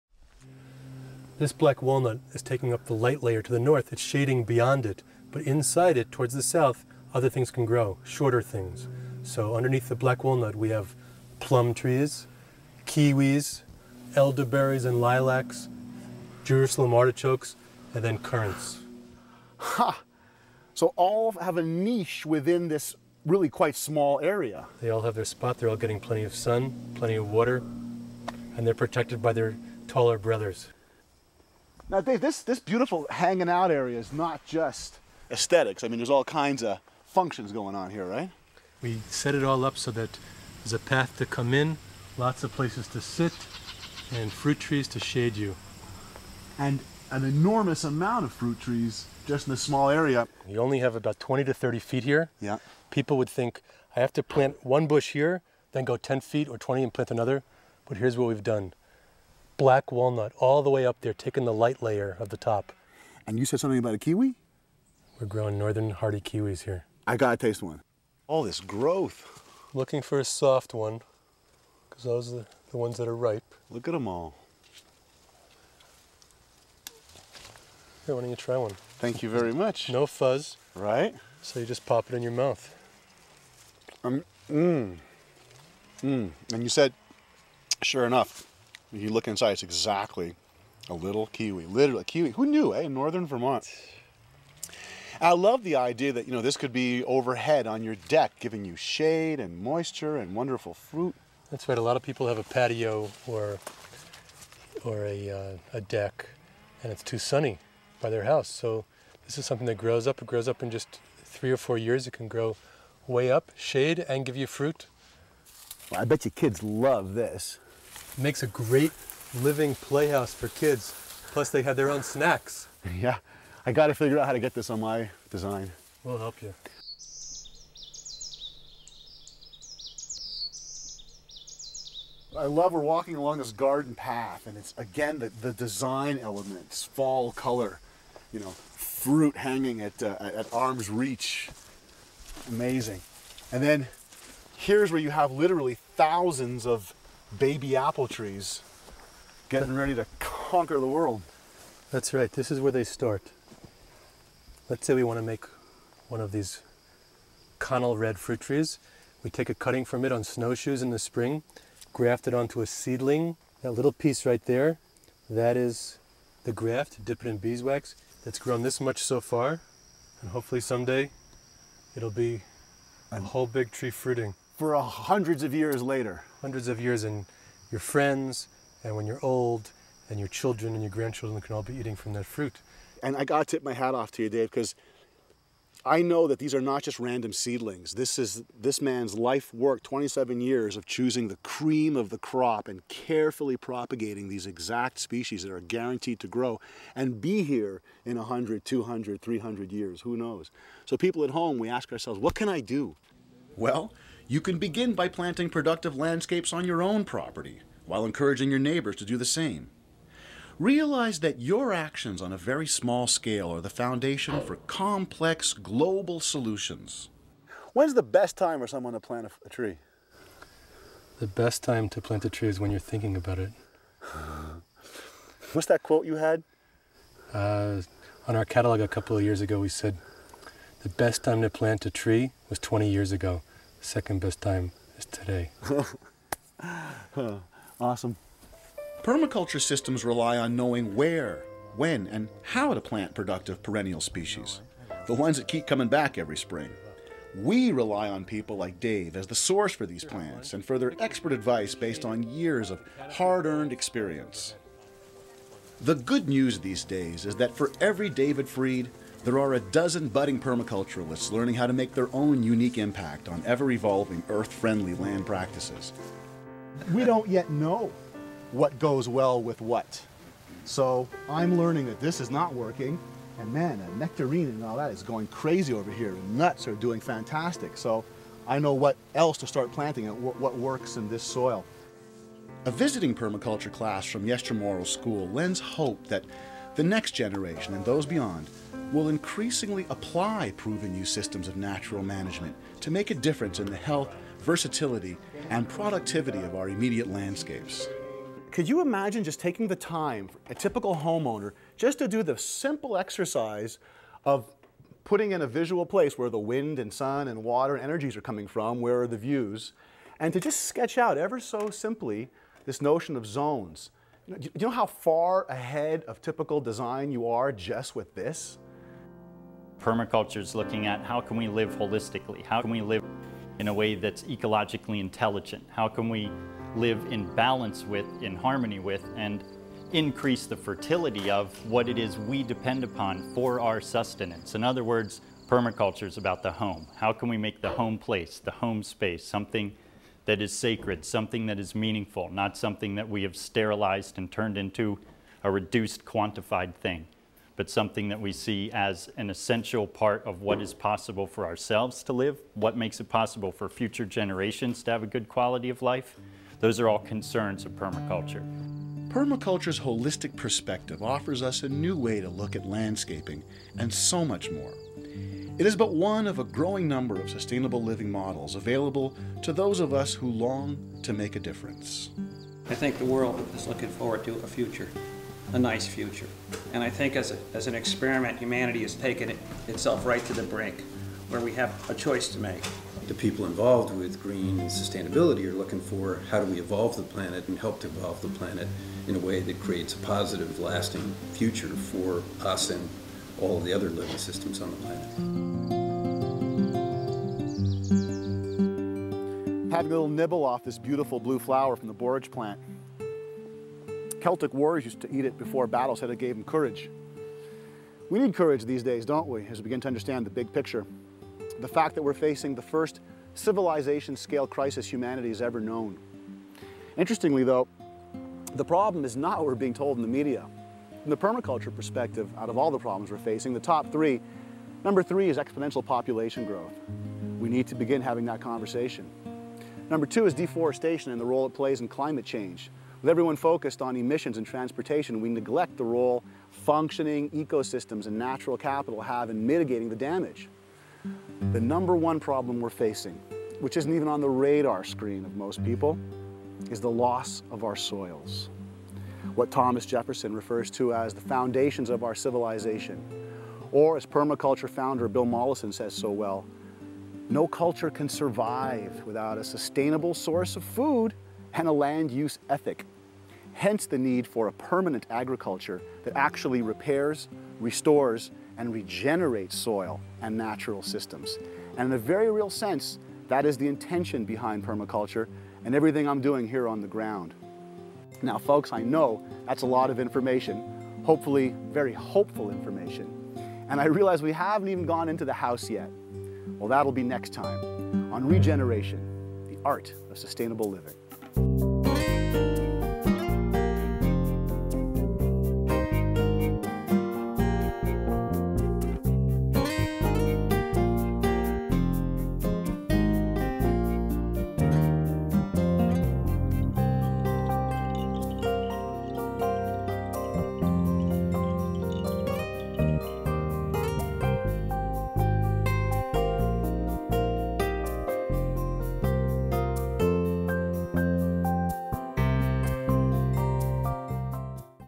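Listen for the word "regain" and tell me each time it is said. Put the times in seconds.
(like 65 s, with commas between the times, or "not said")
not said.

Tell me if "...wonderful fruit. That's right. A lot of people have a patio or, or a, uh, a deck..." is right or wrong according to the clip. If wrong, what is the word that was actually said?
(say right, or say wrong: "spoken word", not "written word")
right.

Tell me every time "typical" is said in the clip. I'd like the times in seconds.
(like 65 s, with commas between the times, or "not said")
300 s, 316 s.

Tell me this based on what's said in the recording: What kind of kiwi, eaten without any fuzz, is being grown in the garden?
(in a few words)
northern hardy kiwis.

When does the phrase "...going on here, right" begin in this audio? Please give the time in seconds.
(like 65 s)
37 s.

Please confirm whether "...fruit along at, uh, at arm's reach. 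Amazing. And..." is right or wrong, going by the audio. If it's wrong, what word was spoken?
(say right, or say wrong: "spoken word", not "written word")
wrong: "hanging", not "along".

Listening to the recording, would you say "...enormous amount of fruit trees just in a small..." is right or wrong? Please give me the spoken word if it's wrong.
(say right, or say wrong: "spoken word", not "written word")
right.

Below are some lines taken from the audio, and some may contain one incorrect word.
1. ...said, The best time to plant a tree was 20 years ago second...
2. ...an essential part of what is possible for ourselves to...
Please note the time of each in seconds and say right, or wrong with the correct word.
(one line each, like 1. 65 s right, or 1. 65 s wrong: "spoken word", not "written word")
1. 229 s right
2. 349 s right.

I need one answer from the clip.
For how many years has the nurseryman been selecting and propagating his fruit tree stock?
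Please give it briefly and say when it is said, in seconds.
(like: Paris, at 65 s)
27 years, at 189 s.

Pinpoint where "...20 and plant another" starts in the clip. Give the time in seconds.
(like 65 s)
56 s.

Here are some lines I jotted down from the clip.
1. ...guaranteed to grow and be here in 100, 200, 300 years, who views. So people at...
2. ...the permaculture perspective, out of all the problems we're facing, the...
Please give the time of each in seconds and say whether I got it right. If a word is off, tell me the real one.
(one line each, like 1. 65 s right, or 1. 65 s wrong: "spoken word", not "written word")
1. 195 s wrong: "knows", not "views"
2. 421 s right.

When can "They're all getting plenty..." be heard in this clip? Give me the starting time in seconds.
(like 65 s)
25 s.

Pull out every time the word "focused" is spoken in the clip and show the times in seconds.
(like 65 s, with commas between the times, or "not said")
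433 s.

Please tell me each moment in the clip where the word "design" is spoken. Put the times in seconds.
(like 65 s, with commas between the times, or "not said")
125 s, 135 s, 316 s.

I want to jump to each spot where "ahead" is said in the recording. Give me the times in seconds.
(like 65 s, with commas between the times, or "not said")
315 s.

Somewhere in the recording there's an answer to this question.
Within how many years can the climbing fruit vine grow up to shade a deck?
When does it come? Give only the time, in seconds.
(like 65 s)
111 s.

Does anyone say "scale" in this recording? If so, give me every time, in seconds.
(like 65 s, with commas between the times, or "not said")
213 s, 414 s.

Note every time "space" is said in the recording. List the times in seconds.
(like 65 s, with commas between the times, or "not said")
338 s.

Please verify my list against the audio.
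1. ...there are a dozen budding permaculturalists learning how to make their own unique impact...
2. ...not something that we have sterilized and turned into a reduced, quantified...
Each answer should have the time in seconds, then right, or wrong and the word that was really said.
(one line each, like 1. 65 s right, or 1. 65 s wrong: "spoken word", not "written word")
1. 259 s right
2. 342 s right.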